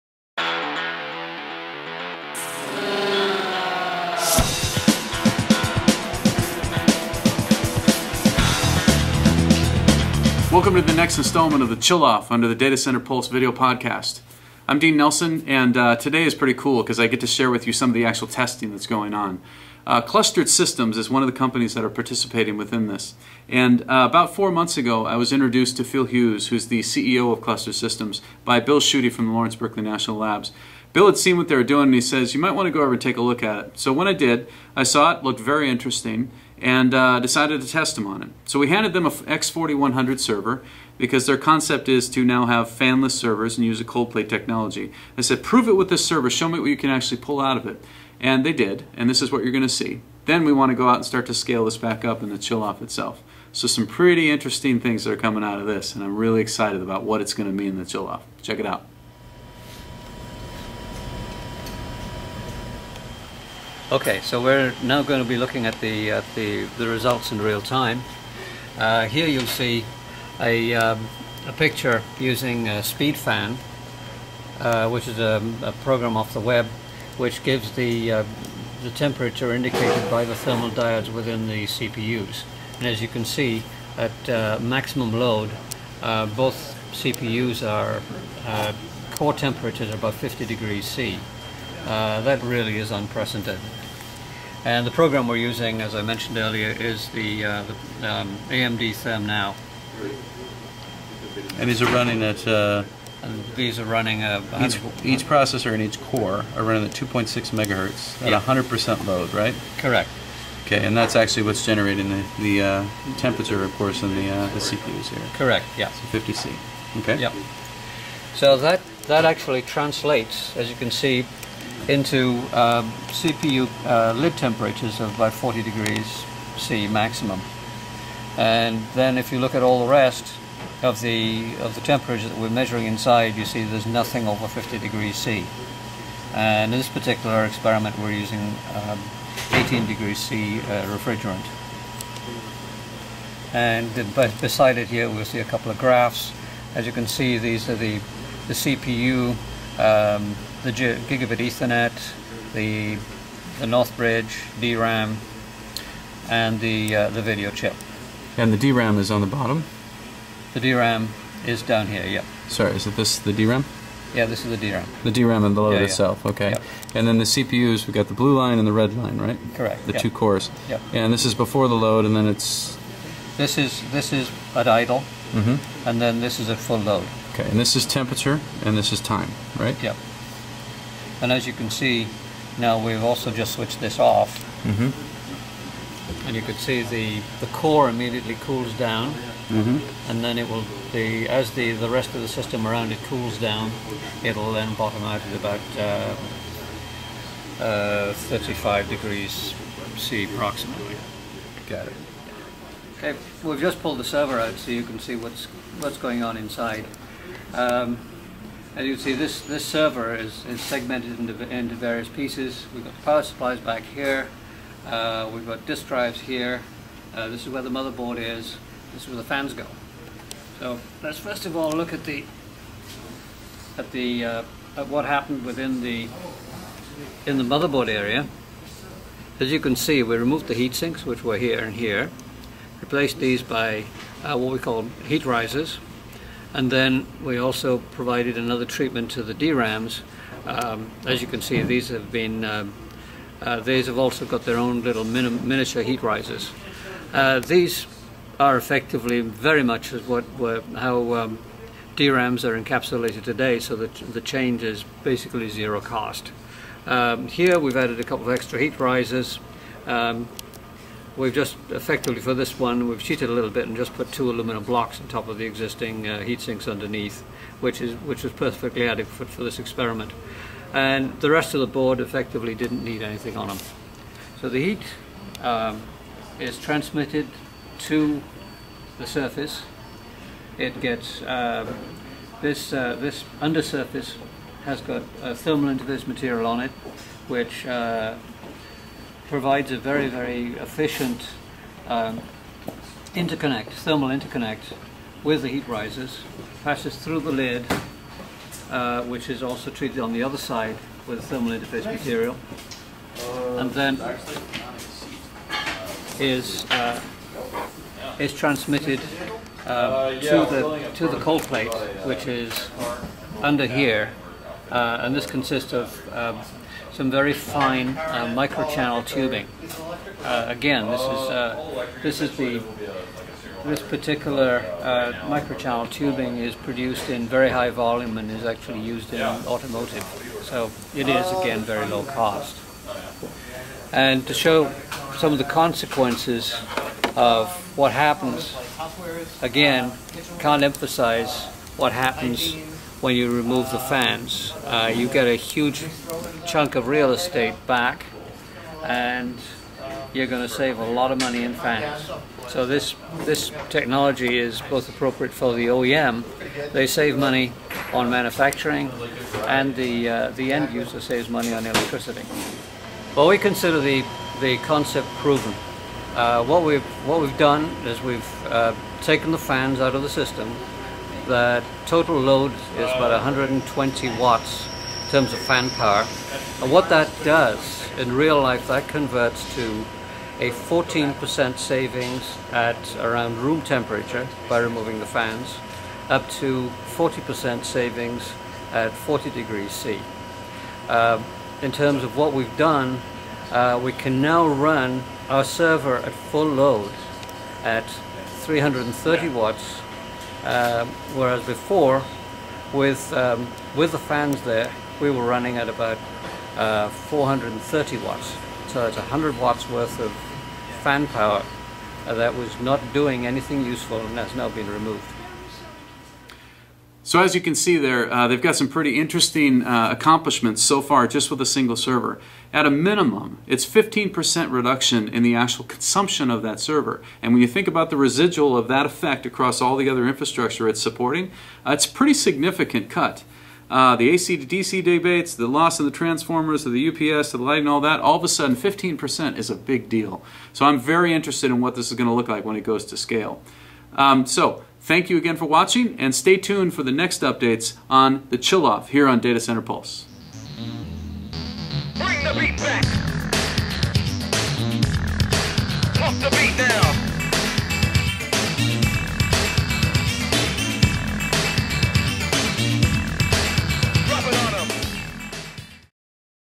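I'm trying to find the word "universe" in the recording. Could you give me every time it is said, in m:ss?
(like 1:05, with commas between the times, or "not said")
not said.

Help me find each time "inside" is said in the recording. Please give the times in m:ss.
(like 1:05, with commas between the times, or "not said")
2:12, 3:26.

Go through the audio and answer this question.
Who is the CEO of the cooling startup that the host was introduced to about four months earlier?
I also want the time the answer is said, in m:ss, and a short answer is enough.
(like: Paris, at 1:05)
Phil Hughes, at 0:25.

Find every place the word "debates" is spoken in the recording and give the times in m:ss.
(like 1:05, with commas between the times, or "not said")
7:14.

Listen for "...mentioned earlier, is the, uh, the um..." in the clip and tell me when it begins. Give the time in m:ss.
1:36.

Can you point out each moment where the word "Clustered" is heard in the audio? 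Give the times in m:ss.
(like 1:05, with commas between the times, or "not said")
0:20, 0:27.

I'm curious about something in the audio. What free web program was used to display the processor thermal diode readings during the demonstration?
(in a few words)
SpeedFan.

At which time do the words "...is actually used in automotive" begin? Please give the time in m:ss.
5:28.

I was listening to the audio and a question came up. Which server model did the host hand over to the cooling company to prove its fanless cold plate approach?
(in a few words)
X4100.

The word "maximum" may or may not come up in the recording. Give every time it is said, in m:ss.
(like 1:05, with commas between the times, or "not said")
1:24, 2:06.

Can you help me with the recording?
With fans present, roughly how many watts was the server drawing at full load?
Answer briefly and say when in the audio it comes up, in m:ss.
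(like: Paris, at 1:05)
430 watts, at 6:46.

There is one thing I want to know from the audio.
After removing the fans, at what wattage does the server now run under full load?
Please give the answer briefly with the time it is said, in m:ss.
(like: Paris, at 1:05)
330 watts, at 6:38.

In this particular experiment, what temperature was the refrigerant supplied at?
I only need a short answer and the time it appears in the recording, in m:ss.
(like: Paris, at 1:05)
18 degrees C, at 2:19.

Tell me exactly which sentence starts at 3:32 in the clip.
We've got power supplies back here.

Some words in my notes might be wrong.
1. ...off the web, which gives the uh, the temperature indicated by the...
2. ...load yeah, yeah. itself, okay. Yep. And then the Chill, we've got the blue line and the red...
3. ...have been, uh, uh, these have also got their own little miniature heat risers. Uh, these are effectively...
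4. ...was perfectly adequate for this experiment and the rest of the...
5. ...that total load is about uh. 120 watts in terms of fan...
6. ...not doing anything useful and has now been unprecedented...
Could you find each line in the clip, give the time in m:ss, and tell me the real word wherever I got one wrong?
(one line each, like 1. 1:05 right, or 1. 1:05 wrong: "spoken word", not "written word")
1. 1:16 right
2. 2:45 wrong: "CPUs", not "Chill"
3. 4:01 right
4. 4:28 right
5. 6:11 right
6. 6:52 wrong: "removed", not "unprecedented".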